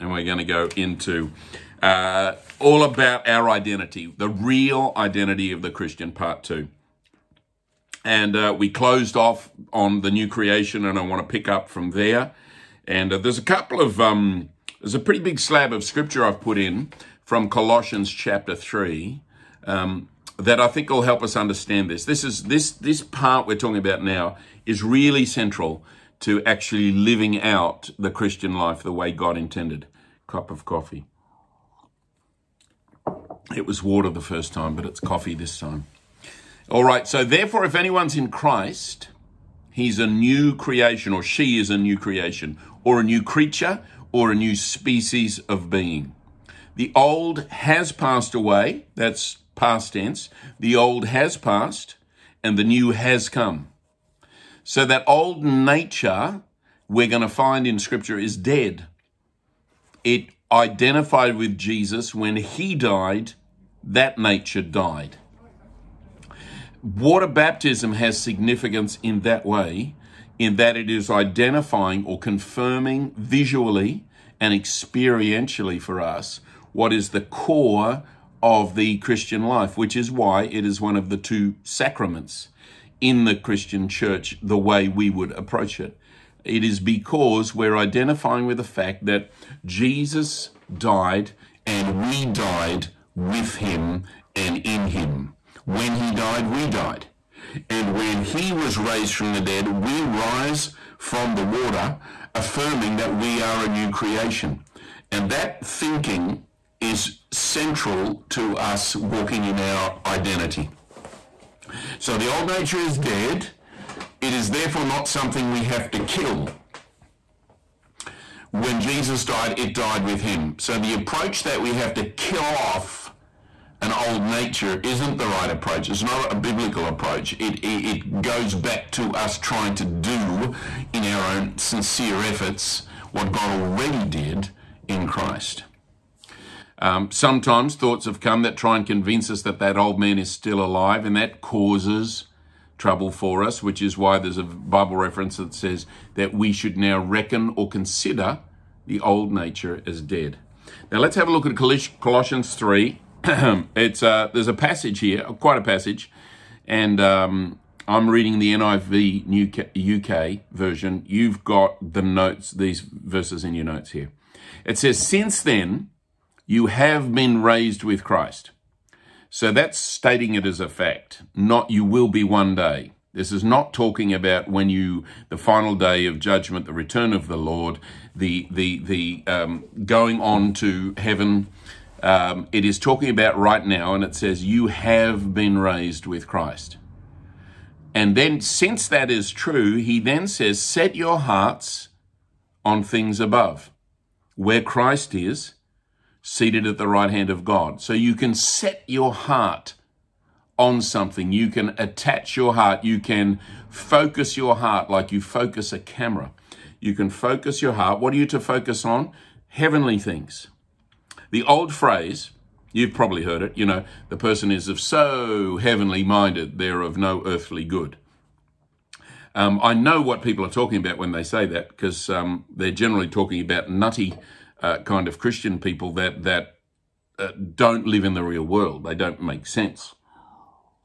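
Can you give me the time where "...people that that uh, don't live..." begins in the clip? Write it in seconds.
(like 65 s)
225 s.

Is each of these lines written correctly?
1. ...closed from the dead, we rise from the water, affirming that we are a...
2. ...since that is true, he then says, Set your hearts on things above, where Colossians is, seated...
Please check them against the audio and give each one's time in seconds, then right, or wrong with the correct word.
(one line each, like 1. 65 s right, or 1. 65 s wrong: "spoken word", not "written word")
1. 98 s wrong: "raised", not "closed"
2. 188 s wrong: "Christ", not "Colossians".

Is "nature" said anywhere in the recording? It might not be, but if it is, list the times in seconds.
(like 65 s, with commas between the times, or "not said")
55 s, 64 s, 112 s, 124 s, 149 s.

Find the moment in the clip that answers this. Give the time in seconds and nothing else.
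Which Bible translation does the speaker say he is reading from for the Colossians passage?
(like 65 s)
158 s.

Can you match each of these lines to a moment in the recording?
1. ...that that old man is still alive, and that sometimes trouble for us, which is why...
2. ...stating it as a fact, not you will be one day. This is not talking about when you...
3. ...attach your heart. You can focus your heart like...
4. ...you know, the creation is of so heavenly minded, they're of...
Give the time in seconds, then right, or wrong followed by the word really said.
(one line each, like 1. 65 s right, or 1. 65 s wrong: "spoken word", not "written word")
1. 139 s wrong: "causes", not "sometimes"
2. 169 s right
3. 201 s right
4. 213 s wrong: "person", not "creation".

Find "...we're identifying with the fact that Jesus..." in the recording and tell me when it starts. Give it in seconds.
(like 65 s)
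87 s.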